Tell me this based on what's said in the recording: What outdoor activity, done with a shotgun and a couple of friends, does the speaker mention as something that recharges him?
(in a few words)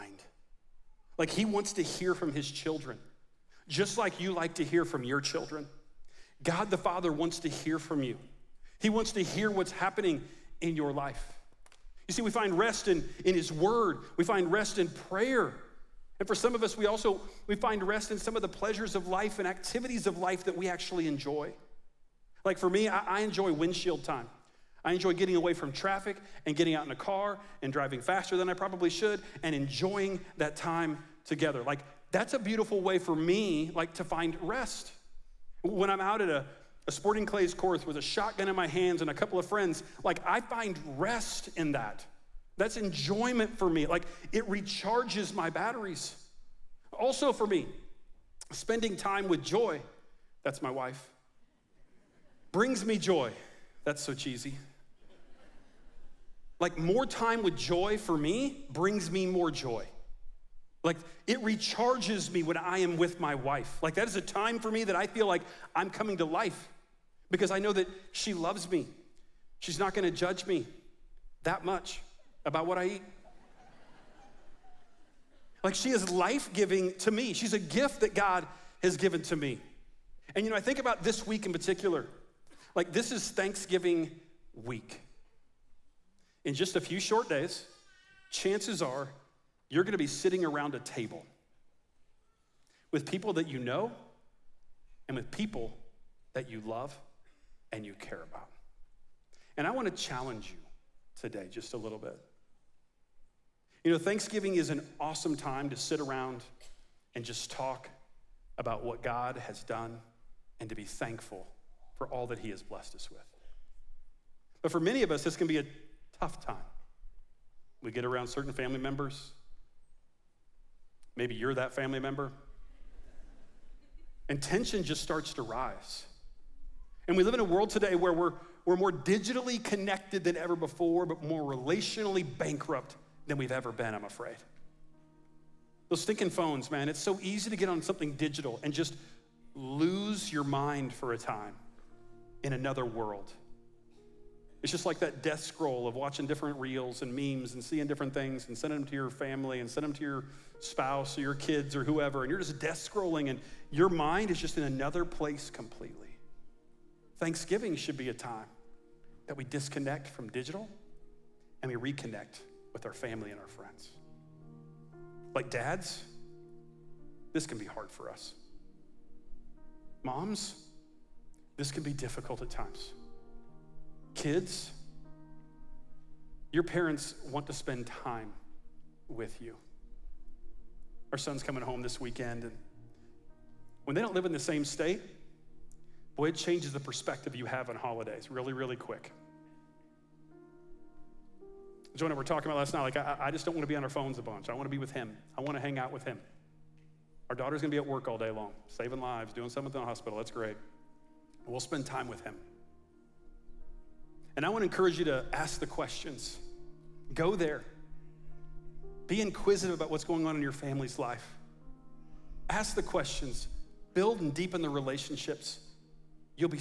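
sporting clays.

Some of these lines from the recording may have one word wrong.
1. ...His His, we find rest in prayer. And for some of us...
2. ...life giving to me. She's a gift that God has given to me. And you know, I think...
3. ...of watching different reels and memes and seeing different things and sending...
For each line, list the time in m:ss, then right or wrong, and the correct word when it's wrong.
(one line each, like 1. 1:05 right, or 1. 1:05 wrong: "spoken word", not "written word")
1. 0:13 wrong: "Word", not "His"
2. 1:16 right
3. 2:25 right.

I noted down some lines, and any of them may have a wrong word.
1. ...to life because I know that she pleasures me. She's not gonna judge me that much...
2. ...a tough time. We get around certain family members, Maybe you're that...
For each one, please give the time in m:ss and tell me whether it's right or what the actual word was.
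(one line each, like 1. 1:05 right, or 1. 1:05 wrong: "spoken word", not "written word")
1. 1:06 wrong: "loves", not "pleasures"
2. 1:55 right.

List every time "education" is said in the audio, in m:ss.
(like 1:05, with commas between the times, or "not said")
not said.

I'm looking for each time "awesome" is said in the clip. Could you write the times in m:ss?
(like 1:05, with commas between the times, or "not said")
1:44.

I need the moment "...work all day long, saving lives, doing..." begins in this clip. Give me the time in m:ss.
3:17.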